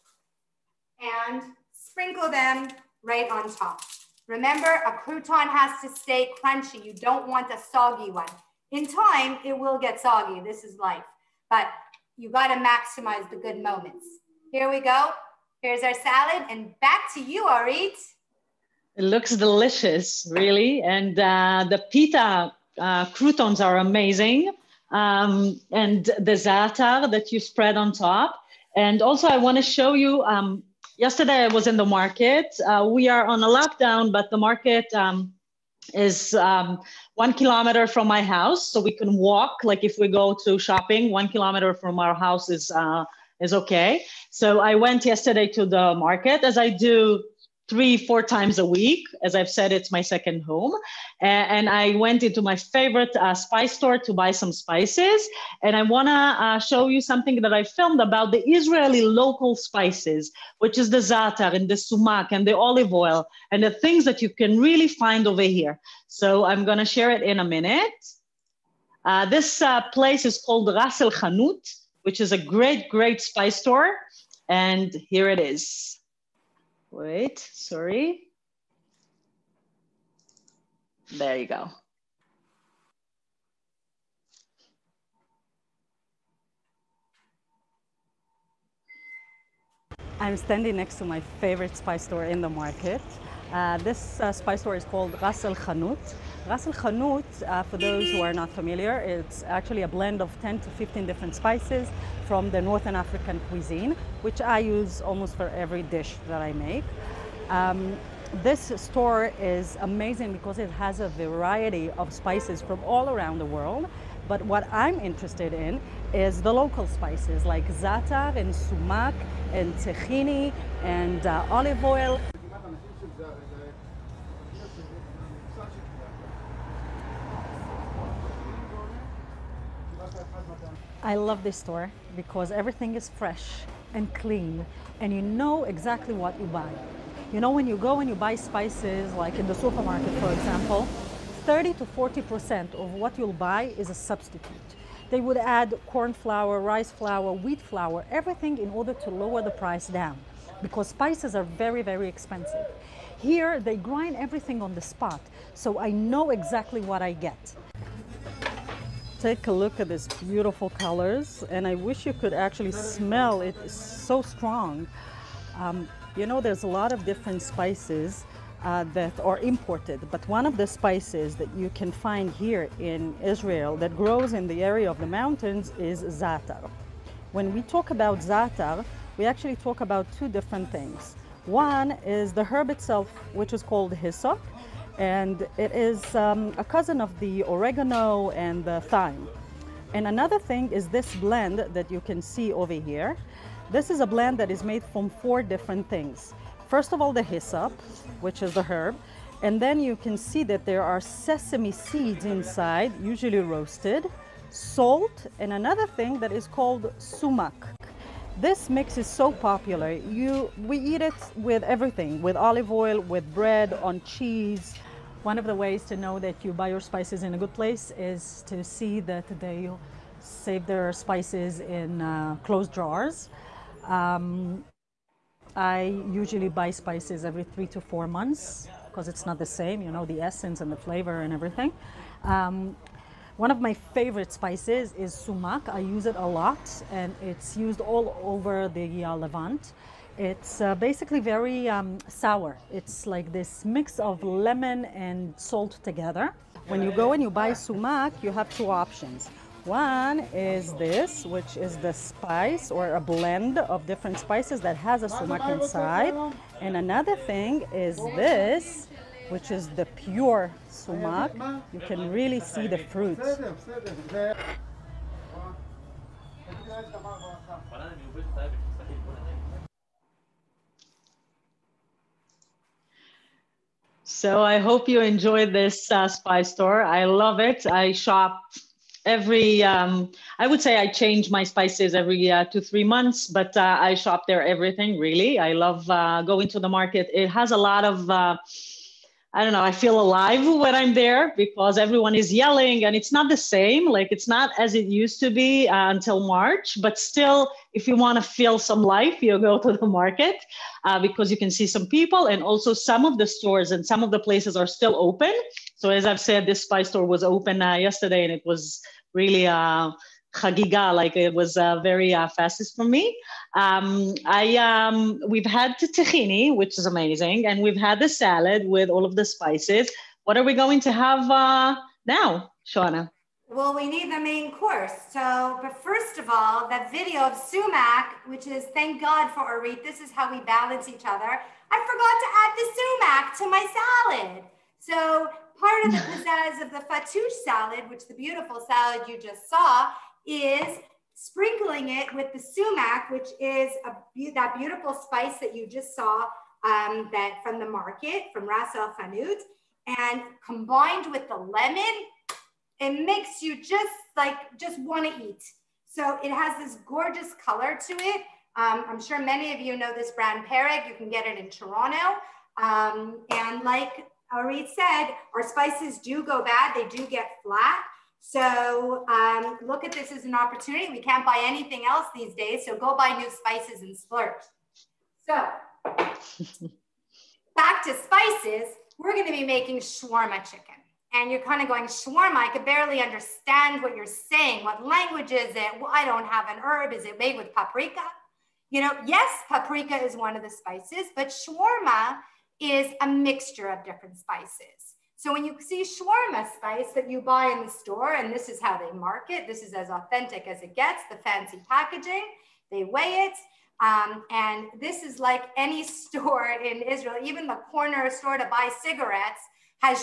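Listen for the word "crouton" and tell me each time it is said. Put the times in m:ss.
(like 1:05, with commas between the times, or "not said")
0:05, 0:23.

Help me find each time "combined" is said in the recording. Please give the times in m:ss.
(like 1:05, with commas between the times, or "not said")
5:50.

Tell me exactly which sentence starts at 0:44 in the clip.
So I went yesterday to the market as I do three, four times a week.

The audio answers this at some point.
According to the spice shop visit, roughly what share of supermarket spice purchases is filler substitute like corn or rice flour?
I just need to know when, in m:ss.
2:21.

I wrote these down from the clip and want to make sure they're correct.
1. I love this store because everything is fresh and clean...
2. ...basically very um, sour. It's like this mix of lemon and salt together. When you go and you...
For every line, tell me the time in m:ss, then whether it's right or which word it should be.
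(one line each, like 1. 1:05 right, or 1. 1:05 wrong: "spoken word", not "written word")
1. 2:11 right
2. 4:00 right.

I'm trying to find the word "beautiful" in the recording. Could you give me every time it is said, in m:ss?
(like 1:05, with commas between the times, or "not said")
2:40, 5:38, 5:44.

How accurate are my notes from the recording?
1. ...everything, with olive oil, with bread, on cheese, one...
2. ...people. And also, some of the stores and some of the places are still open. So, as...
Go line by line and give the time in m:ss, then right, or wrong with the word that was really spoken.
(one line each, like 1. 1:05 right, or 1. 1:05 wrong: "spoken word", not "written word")
1. 3:31 right
2. 5:01 right.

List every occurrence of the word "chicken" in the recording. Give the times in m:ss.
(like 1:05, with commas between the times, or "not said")
6:20.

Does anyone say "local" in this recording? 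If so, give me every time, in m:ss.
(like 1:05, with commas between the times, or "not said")
0:59, 1:56.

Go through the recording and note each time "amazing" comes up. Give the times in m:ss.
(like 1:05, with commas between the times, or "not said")
0:23, 1:49, 5:16.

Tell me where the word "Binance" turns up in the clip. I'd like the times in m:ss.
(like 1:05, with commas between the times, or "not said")
not said.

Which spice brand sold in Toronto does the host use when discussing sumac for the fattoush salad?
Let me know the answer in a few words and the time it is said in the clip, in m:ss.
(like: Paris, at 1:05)
Pereg, at 6:00.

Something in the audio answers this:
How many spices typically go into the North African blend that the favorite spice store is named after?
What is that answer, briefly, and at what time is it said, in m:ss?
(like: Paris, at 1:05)
10 to 15, at 1:40.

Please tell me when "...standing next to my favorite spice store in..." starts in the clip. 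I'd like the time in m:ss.
1:30.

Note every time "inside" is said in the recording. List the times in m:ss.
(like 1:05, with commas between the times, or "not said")
3:22, 4:15.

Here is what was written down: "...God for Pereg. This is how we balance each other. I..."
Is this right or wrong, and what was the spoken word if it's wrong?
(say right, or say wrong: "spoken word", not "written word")
wrong: "Orit", not "Pereg".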